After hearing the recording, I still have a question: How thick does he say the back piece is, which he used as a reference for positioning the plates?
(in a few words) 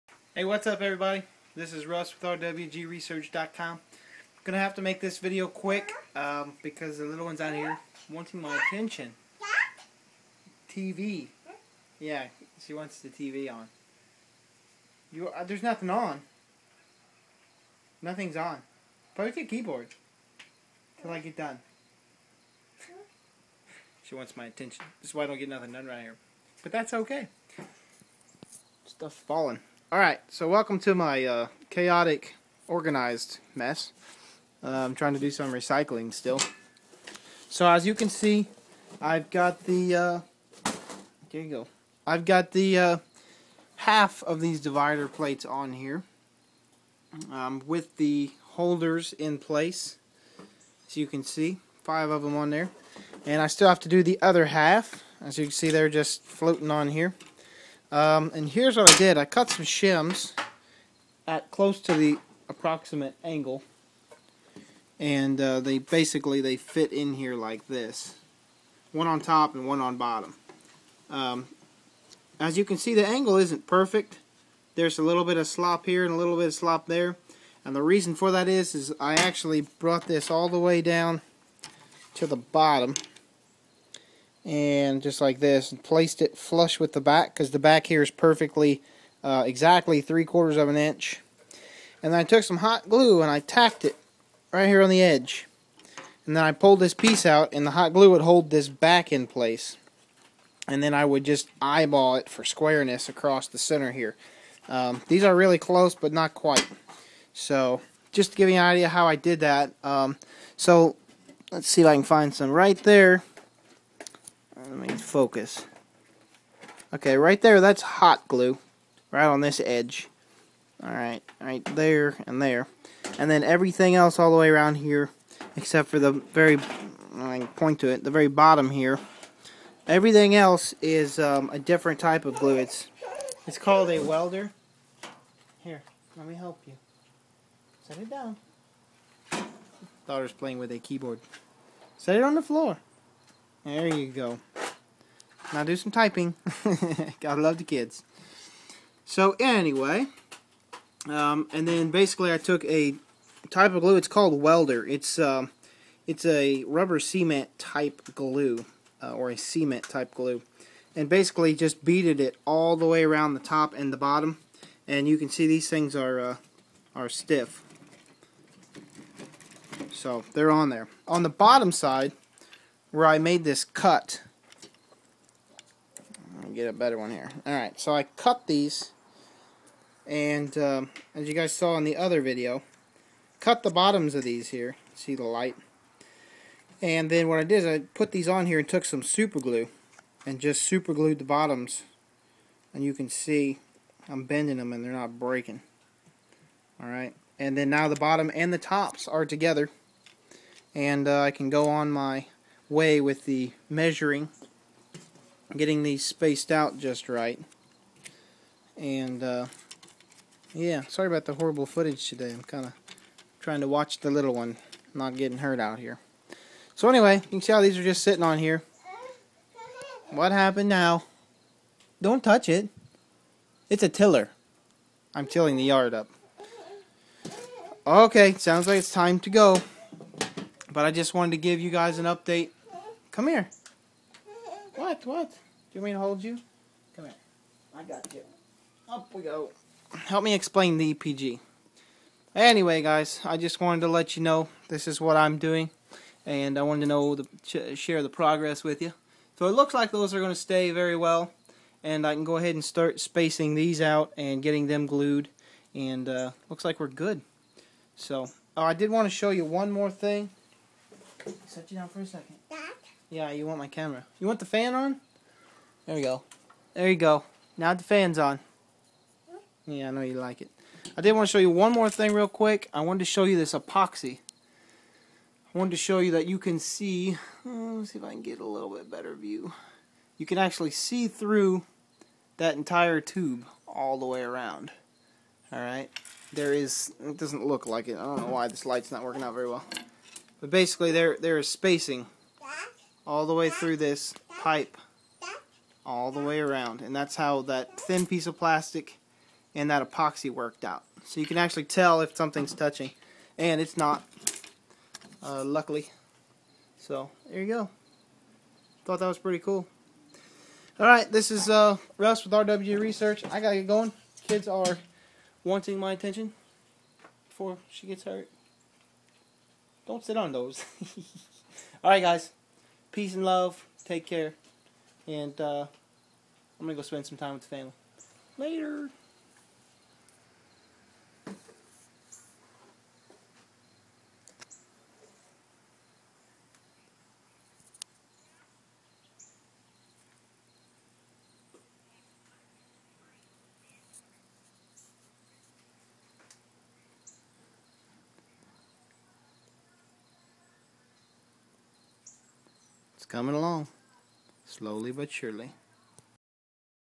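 3/4 of an inch.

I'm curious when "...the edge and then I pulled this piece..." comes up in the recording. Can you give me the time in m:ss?
1:34.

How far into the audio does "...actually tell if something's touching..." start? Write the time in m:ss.
5:01.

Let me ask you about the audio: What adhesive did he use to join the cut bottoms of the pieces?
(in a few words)
Super glue.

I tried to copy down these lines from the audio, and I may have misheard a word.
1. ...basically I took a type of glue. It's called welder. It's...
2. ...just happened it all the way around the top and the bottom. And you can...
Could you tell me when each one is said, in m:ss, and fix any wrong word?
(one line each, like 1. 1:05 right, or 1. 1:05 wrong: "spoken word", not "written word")
1. 2:31 right
2. 2:41 wrong: "beaded", not "happened".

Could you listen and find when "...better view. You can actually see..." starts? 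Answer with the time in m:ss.
4:38.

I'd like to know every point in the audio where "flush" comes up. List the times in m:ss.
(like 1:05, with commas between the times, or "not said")
1:26.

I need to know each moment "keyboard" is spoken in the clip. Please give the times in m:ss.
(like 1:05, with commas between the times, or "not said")
0:19, 2:20.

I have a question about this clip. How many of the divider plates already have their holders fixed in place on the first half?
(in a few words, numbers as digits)
5.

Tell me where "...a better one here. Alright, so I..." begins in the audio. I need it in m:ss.
2:56.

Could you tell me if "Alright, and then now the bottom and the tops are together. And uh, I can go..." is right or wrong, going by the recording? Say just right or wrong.
right.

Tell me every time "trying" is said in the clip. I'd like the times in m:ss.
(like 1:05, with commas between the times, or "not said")
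0:34, 3:33.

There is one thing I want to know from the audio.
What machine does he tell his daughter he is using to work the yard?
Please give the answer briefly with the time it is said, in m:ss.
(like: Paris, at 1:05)
A tiller, at 3:43.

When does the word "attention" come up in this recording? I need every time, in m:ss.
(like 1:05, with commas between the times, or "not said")
0:08, 0:24, 5:15.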